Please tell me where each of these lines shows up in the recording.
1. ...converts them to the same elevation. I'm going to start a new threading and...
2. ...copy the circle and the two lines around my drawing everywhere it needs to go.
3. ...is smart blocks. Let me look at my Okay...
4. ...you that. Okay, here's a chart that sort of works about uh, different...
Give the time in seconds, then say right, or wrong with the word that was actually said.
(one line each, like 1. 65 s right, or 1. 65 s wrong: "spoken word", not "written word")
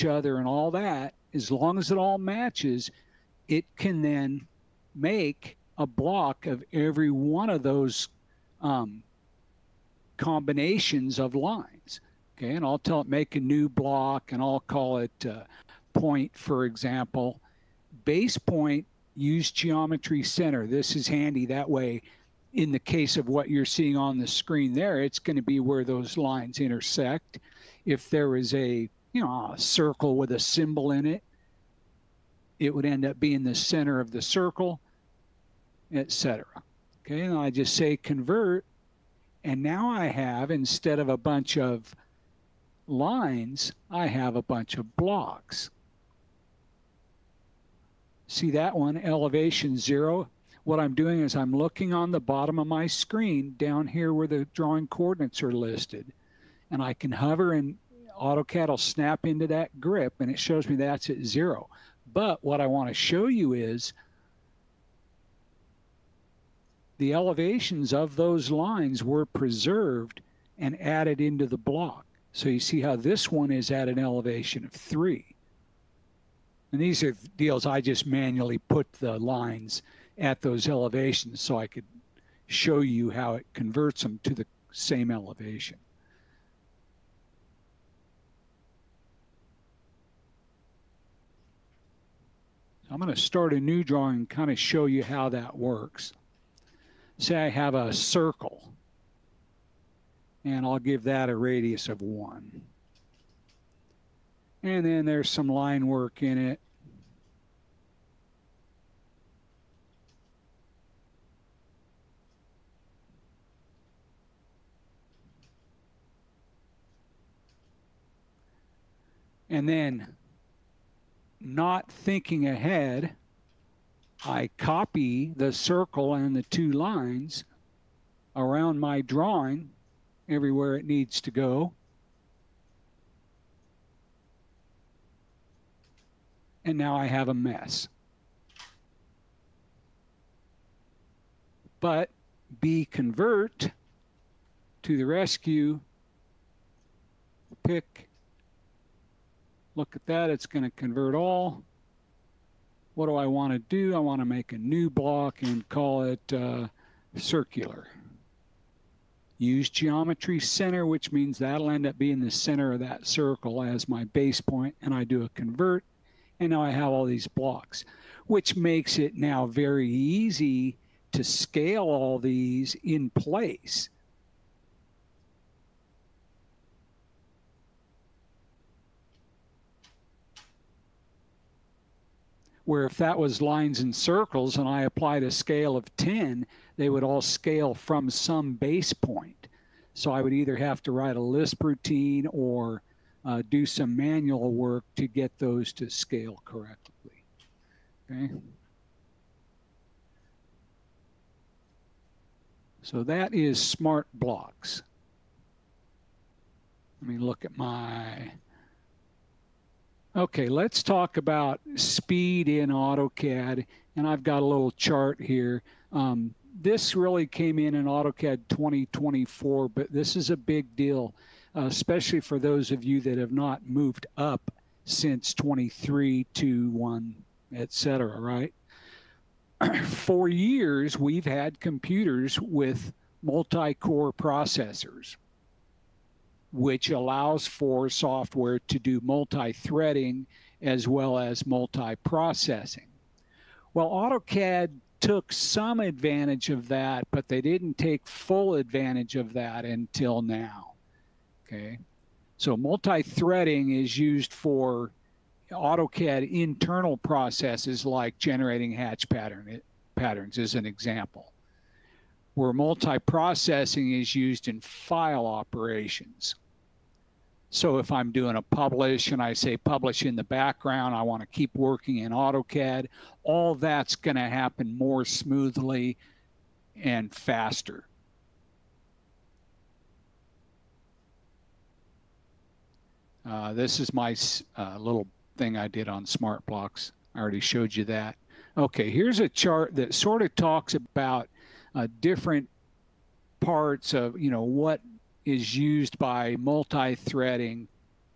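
1. 83 s wrong: "drawing", not "threading"
2. 124 s right
3. 203 s right
4. 287 s wrong: "talks", not "works".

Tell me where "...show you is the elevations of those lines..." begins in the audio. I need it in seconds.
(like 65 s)
62 s.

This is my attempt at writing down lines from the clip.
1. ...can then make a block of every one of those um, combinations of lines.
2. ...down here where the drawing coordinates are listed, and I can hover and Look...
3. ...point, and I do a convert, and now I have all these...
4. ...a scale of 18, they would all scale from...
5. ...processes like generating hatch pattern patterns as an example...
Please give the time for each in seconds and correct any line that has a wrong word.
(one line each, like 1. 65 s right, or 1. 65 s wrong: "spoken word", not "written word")
1. 3 s right
2. 53 s wrong: "AutoCAD", not "Look"
3. 164 s right
4. 185 s wrong: "10", not "18"
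5. 256 s right.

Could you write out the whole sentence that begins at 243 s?
Well, AutoCAD took some advantage of that, but they didn't take full advantage of that until now.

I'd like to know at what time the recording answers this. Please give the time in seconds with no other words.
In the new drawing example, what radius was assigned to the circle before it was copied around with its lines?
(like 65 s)
101 s.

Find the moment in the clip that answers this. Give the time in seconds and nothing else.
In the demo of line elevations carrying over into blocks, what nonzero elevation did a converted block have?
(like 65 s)
74 s.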